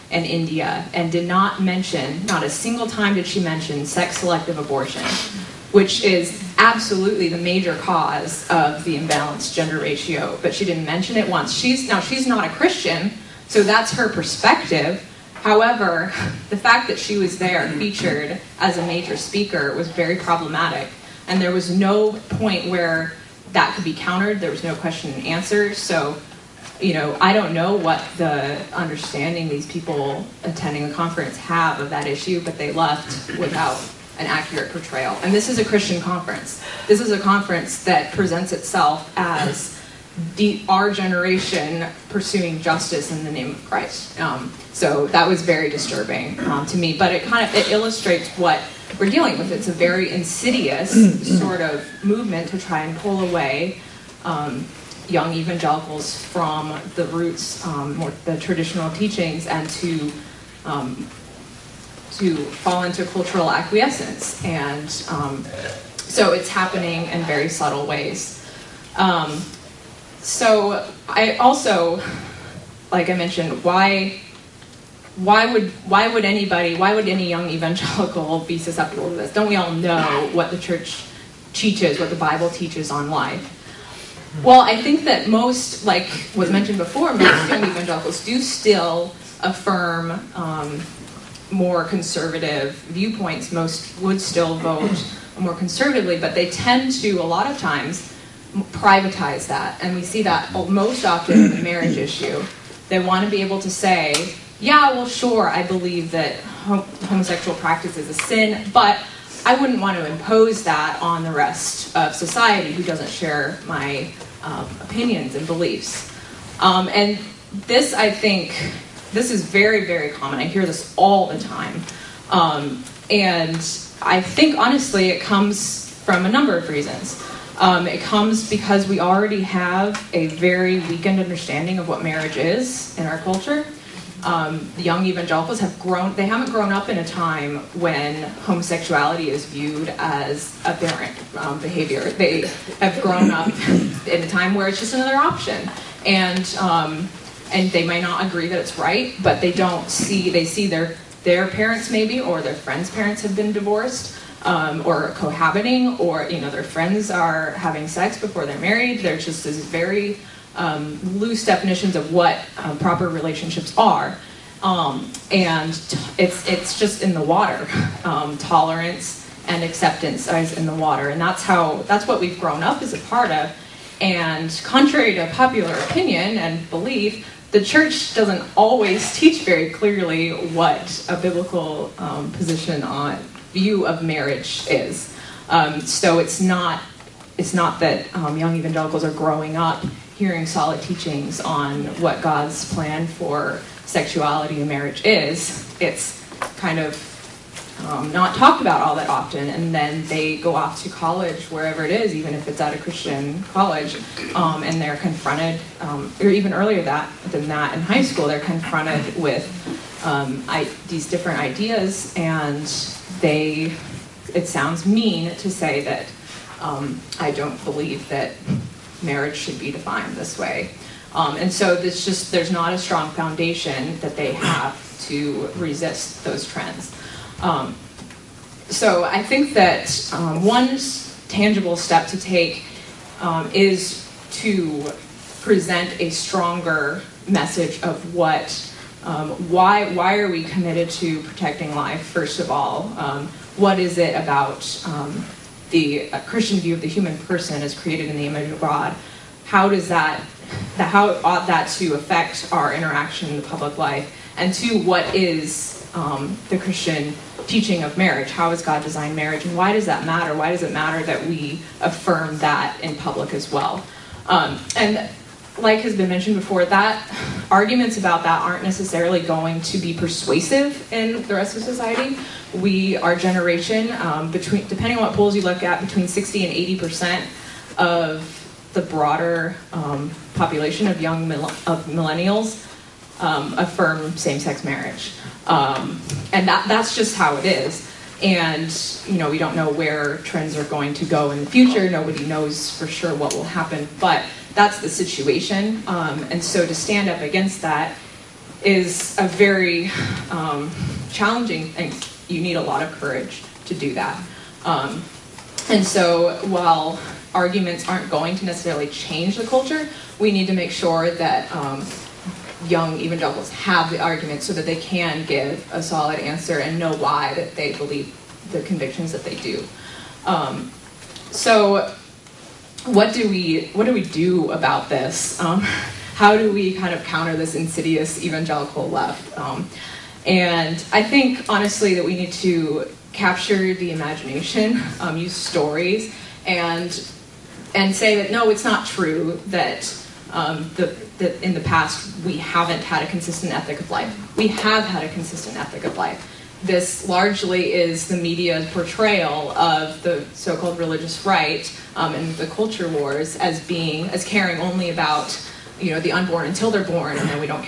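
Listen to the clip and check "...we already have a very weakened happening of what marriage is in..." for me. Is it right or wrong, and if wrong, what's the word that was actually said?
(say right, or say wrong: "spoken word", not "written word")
wrong: "understanding", not "happening".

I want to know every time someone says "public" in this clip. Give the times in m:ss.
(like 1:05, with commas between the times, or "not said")
4:13, 4:22.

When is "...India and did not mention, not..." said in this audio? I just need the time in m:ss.
0:00.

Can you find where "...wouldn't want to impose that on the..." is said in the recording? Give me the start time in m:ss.
1:49.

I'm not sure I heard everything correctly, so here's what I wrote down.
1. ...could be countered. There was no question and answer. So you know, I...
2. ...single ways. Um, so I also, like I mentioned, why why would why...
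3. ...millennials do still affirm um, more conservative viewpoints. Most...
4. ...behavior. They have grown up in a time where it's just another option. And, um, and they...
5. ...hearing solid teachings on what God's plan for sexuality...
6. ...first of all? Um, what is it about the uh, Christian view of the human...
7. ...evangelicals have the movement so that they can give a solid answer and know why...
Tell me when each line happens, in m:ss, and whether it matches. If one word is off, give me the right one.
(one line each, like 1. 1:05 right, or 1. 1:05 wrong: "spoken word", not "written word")
1. 0:23 right
2. 1:07 wrong: "subtle", not "single"
3. 1:27 wrong: "evangelicals", not "millennials"
4. 2:21 right
5. 3:10 right
6. 4:02 right
7. 5:12 wrong: "argument", not "movement".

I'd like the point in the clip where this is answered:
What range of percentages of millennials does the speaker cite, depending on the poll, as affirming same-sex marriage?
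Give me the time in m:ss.
4:35.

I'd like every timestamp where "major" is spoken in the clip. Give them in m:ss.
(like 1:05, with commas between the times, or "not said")
0:07, 0:18.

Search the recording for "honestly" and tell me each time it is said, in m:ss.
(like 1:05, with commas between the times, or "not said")
2:04, 5:31.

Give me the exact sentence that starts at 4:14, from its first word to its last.
And two, what is um, the Christian teaching of marriage?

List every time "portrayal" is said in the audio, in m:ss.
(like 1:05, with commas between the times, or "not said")
0:34, 5:48.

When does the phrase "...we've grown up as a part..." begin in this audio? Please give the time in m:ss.
2:52.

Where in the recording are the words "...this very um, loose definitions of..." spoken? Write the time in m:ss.
2:39.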